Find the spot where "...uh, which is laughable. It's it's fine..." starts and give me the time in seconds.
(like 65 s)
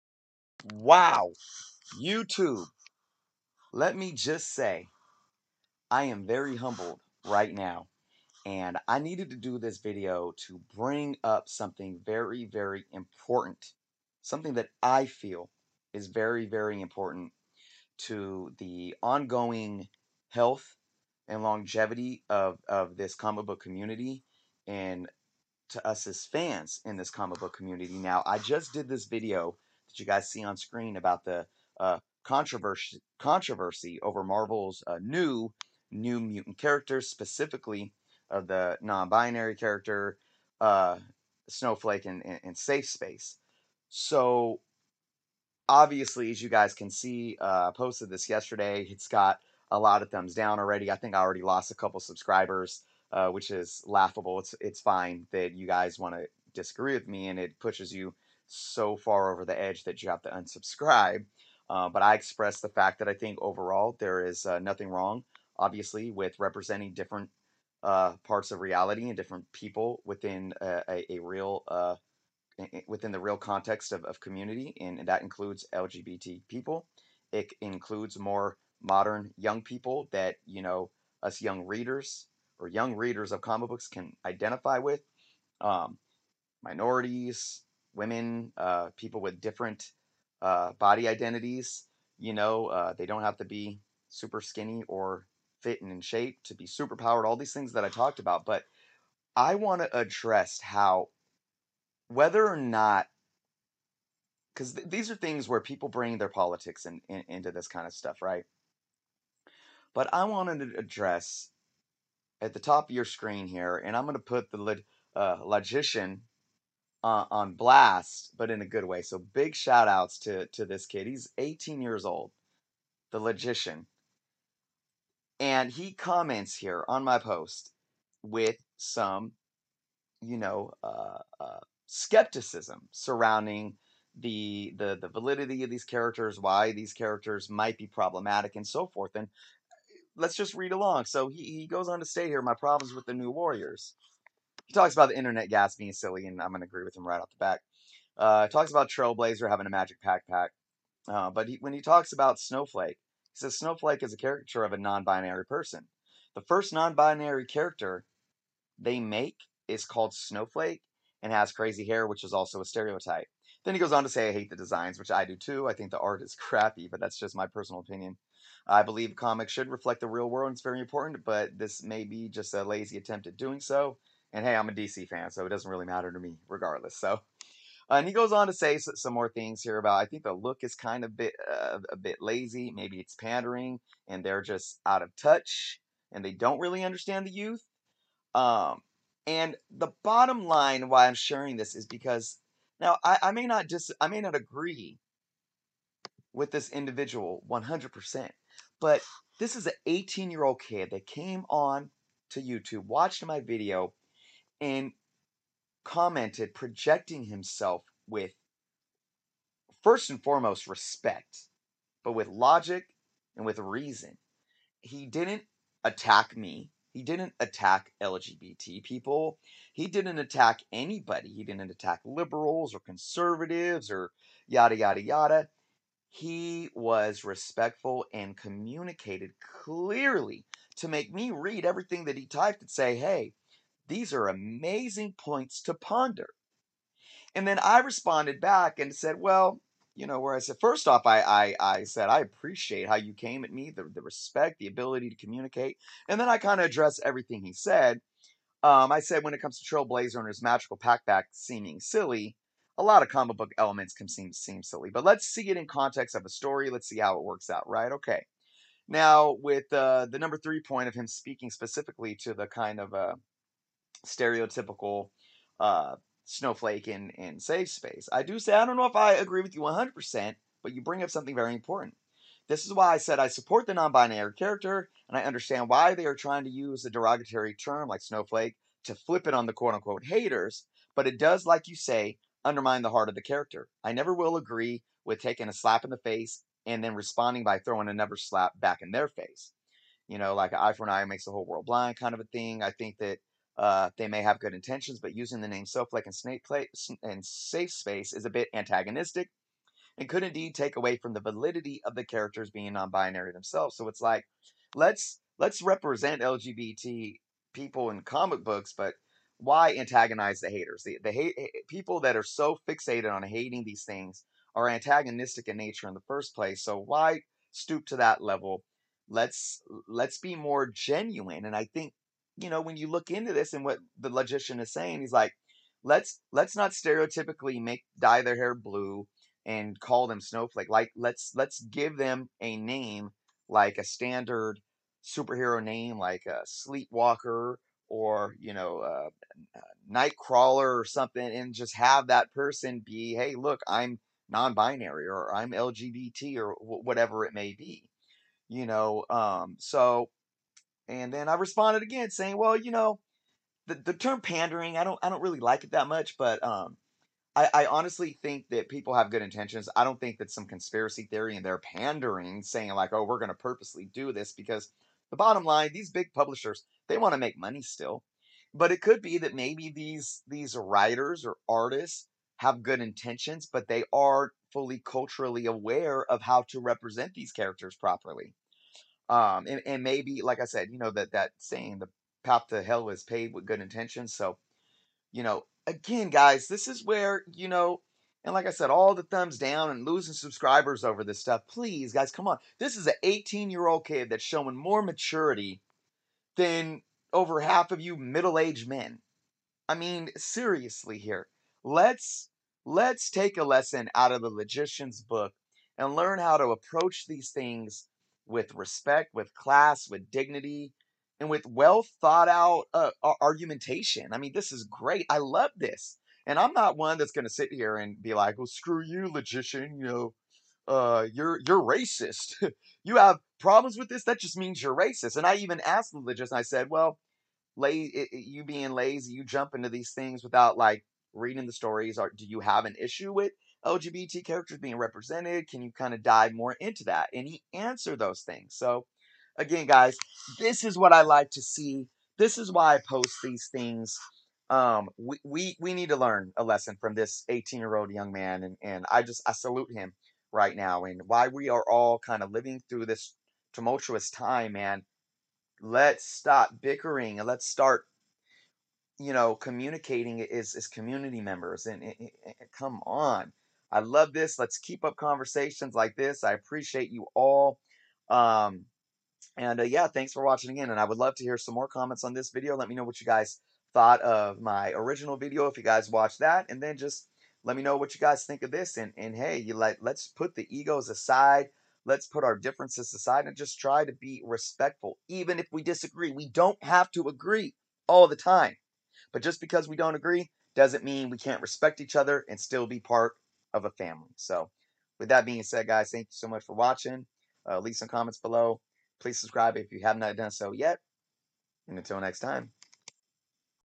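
53 s.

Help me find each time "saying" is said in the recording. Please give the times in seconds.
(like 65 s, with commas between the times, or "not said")
324 s, 352 s, 362 s, 381 s.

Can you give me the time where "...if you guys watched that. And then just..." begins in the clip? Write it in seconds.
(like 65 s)
475 s.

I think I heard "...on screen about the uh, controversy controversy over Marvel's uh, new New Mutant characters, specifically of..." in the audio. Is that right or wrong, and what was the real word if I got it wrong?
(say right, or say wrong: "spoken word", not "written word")
right.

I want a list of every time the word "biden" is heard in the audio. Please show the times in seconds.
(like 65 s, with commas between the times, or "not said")
not said.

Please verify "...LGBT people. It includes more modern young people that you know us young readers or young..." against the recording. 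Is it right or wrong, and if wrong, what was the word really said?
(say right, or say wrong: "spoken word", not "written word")
right.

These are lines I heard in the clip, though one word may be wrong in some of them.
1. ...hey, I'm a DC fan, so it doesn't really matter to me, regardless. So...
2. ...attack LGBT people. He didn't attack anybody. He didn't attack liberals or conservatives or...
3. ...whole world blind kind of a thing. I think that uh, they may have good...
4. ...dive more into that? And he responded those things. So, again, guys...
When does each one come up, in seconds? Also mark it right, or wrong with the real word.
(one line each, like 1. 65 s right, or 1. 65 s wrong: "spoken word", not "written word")
1. 174 s right
2. 217 s right
3. 291 s right
4. 436 s wrong: "answered", not "responded".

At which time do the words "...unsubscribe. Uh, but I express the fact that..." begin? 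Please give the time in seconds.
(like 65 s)
60 s.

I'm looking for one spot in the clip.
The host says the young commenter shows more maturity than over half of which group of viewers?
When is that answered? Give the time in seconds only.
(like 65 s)
397 s.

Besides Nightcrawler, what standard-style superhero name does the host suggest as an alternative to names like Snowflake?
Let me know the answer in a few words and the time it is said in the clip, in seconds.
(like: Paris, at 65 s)
Sleepwalker, at 336 s.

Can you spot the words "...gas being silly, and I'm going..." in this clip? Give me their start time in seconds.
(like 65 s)
145 s.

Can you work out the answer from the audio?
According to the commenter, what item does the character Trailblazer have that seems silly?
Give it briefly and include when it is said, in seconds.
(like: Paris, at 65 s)
A magic pack, at 149 s.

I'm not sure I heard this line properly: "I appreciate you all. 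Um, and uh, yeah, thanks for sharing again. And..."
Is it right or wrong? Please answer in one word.
wrong.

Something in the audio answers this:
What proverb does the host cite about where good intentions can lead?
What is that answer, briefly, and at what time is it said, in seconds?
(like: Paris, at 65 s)
The path to hell is paved with good intentions, at 381 s.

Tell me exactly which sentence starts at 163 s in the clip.
Then he goes on to say, I hate the designs, which I do too.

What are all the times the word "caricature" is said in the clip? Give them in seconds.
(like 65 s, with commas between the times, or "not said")
154 s.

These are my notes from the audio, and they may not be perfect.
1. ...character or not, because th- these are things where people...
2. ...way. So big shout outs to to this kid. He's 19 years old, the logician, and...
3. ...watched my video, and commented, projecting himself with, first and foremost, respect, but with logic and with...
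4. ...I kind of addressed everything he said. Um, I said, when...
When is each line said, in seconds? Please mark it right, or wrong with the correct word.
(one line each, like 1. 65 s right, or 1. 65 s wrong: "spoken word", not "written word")
1. 102 s wrong: "whether", not "character"
2. 118 s wrong: "18", not "19"
3. 202 s right
4. 246 s right.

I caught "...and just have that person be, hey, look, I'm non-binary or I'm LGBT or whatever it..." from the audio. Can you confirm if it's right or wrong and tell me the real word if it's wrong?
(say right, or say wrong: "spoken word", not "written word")
right.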